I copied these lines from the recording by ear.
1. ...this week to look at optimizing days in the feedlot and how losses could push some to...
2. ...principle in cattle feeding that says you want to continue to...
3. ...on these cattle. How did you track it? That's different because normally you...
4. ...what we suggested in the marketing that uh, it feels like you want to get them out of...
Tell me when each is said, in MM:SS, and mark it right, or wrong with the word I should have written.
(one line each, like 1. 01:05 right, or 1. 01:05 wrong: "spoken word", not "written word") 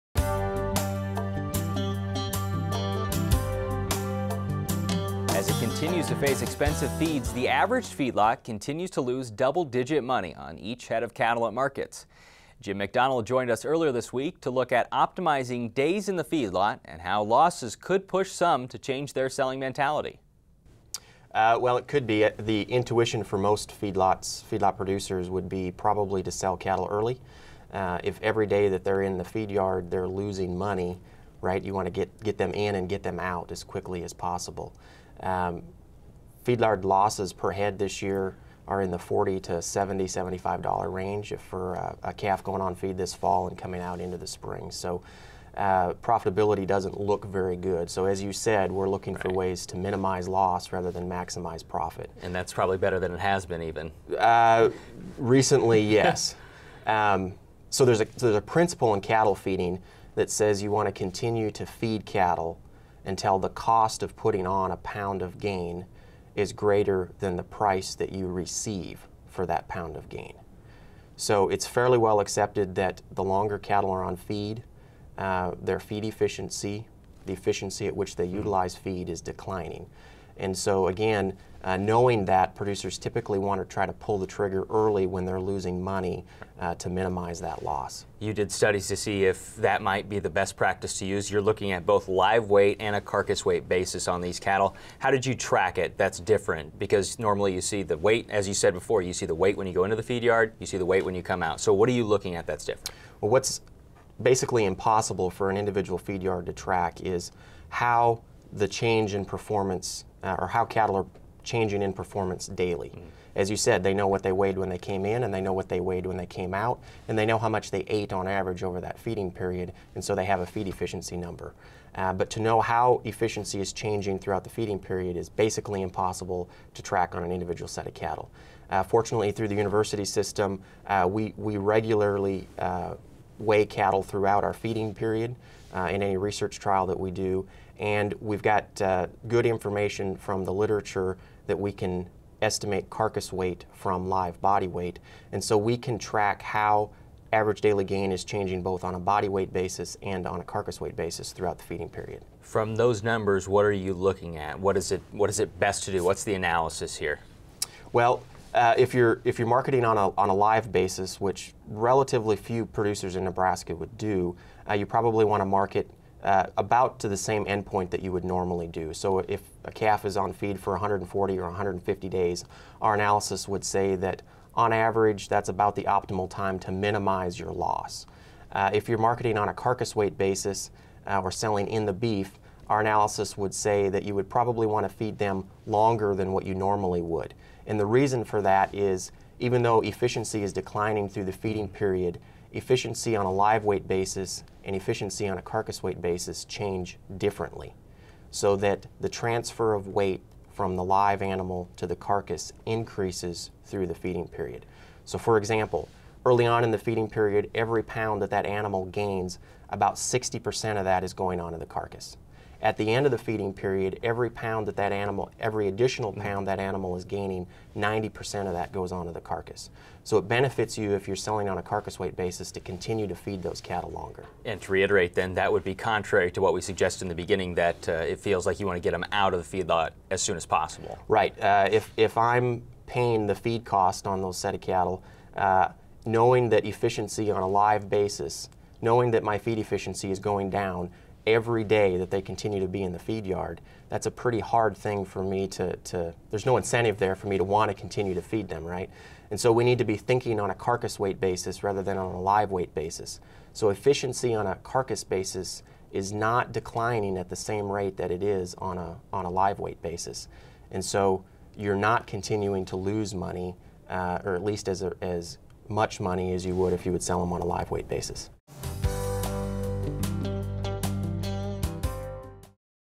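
1. 00:13 right
2. 00:58 right
3. 01:34 right
4. 03:46 wrong: "beginning", not "marketing".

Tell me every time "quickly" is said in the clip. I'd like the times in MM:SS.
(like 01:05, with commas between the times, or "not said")
00:33.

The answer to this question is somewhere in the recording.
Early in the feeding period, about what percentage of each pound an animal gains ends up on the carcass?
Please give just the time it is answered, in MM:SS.
03:29.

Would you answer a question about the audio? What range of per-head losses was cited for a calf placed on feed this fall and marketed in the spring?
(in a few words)
$40 to $75.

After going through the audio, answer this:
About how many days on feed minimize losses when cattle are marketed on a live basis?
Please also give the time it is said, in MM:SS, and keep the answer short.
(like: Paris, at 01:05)
140 or 150 days, at 02:50.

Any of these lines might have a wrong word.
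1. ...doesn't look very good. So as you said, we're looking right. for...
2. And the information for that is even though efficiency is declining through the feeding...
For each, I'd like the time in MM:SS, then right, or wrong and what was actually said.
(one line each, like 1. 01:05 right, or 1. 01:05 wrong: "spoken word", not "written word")
1. 00:46 right
2. 03:07 wrong: "reason", not "information".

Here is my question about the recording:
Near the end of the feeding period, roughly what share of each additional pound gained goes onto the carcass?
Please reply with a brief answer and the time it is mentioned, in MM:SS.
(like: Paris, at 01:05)
90%, at 03:37.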